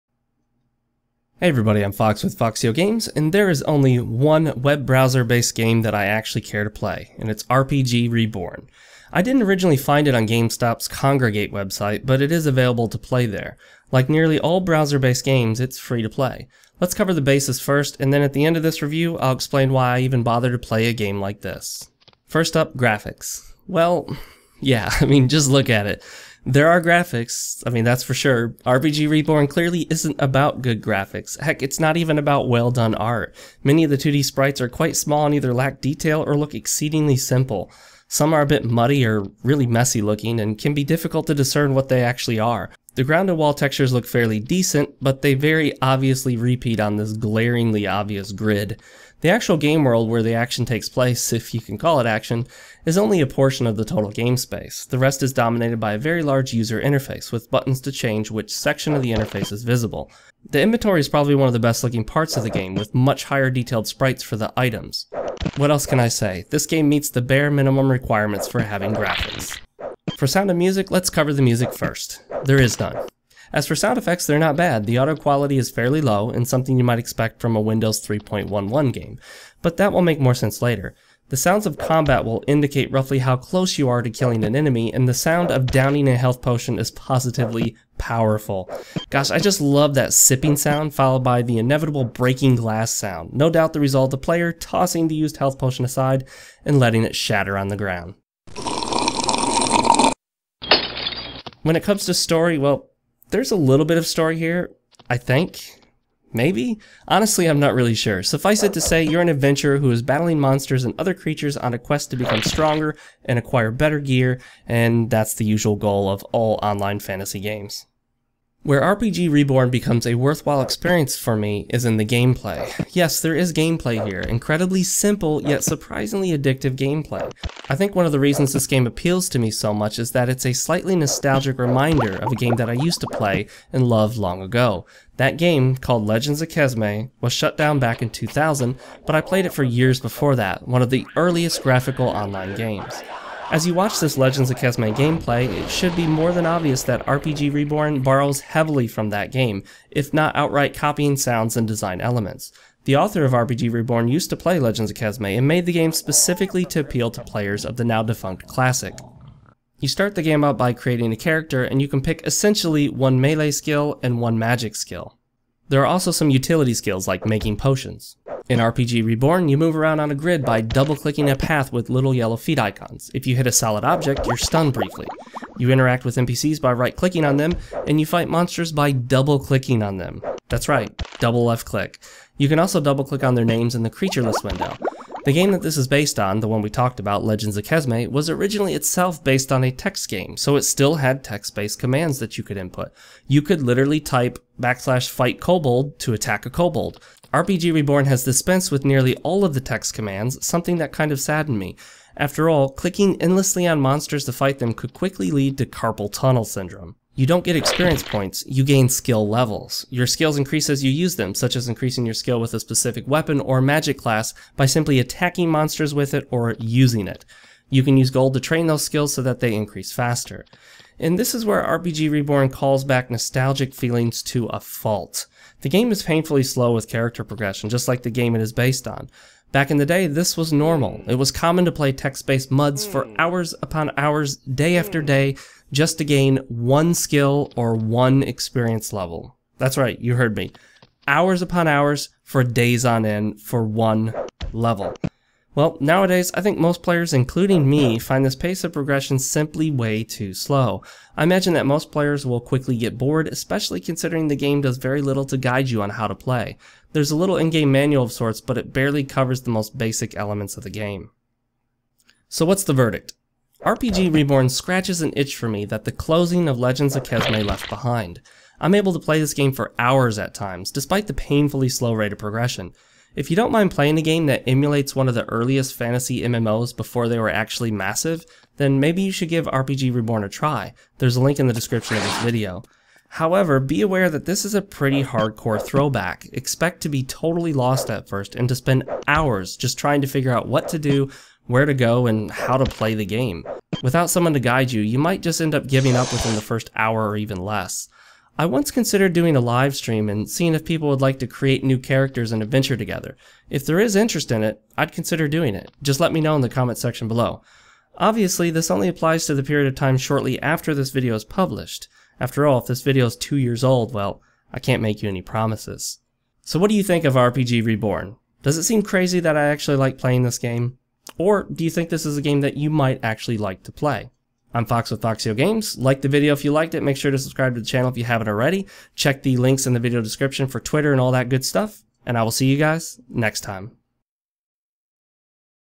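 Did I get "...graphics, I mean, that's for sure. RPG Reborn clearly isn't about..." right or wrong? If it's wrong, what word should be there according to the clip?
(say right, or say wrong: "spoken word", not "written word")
right.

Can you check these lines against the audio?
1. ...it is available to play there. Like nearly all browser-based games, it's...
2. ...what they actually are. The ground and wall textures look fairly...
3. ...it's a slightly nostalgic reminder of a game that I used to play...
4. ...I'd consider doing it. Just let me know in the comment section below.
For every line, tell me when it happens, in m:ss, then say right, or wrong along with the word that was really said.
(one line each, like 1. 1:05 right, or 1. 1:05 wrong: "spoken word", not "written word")
1. 0:12 right
2. 0:41 right
3. 2:10 right
4. 5:04 right.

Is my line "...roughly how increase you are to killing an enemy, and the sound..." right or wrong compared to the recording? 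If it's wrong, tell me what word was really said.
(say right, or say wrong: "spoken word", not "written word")
wrong: "close", not "increase".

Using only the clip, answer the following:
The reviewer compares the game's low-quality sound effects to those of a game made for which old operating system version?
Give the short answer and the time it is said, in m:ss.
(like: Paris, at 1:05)
Windows 3.11, at 1:17.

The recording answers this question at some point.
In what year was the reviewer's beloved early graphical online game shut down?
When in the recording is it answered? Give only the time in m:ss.
2:18.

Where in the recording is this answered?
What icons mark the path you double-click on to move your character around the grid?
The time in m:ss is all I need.
2:51.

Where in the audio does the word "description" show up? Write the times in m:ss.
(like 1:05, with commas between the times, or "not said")
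4:41, 5:30.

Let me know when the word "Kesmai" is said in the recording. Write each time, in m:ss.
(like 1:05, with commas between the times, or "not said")
2:16, 3:07, 4:27.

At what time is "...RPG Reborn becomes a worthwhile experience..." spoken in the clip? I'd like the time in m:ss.
1:58.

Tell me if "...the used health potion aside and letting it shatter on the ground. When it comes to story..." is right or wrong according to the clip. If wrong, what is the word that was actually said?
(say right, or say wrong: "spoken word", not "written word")
right.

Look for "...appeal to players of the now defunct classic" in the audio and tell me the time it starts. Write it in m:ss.
2:36.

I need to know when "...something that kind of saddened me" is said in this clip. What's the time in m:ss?
3:20.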